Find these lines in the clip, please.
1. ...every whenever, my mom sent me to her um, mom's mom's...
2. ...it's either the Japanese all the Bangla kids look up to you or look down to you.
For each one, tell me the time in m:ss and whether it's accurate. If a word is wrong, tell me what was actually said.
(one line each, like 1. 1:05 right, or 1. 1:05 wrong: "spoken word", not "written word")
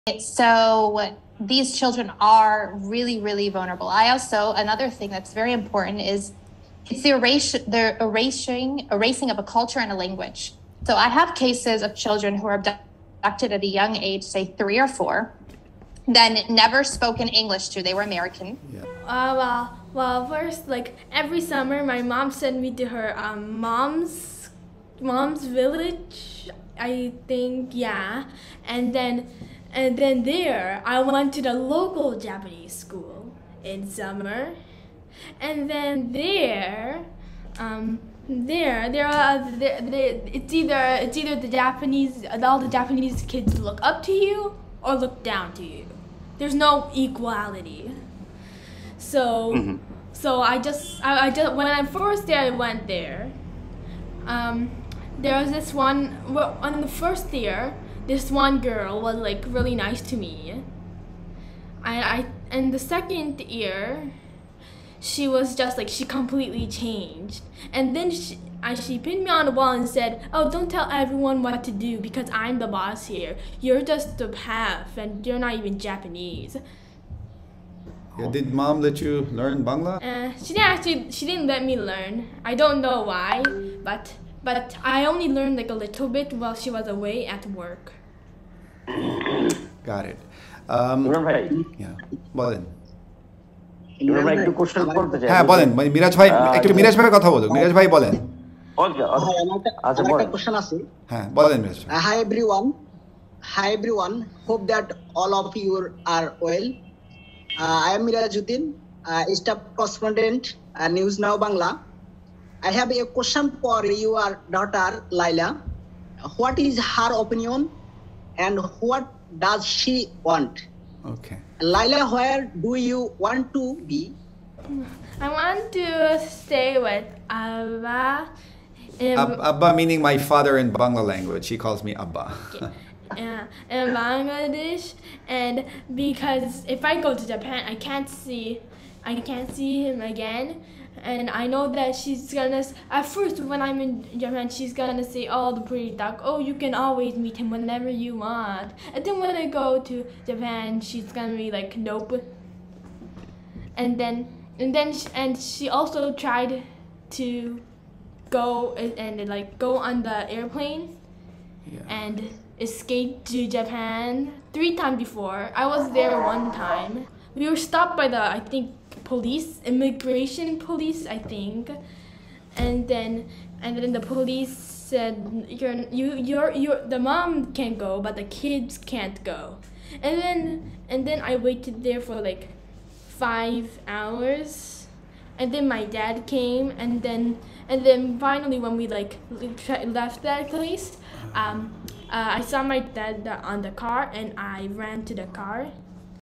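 1. 0:21 wrong: "summer", not "whenever"
2. 0:41 wrong: "Japanese", not "Bangla".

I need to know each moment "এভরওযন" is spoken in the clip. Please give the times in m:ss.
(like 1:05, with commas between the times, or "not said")
1:42.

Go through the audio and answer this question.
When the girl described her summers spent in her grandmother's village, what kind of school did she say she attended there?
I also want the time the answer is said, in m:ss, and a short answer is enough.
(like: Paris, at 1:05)
Japanese school, at 0:31.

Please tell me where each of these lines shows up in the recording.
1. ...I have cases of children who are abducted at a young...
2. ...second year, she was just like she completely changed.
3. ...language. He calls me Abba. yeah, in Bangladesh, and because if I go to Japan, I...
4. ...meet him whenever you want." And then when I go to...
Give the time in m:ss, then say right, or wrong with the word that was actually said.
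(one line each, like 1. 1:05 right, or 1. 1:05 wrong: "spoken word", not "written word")
1. 0:10 right
2. 1:02 right
3. 2:11 right
4. 2:27 right.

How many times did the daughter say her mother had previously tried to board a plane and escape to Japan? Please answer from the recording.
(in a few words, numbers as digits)
3.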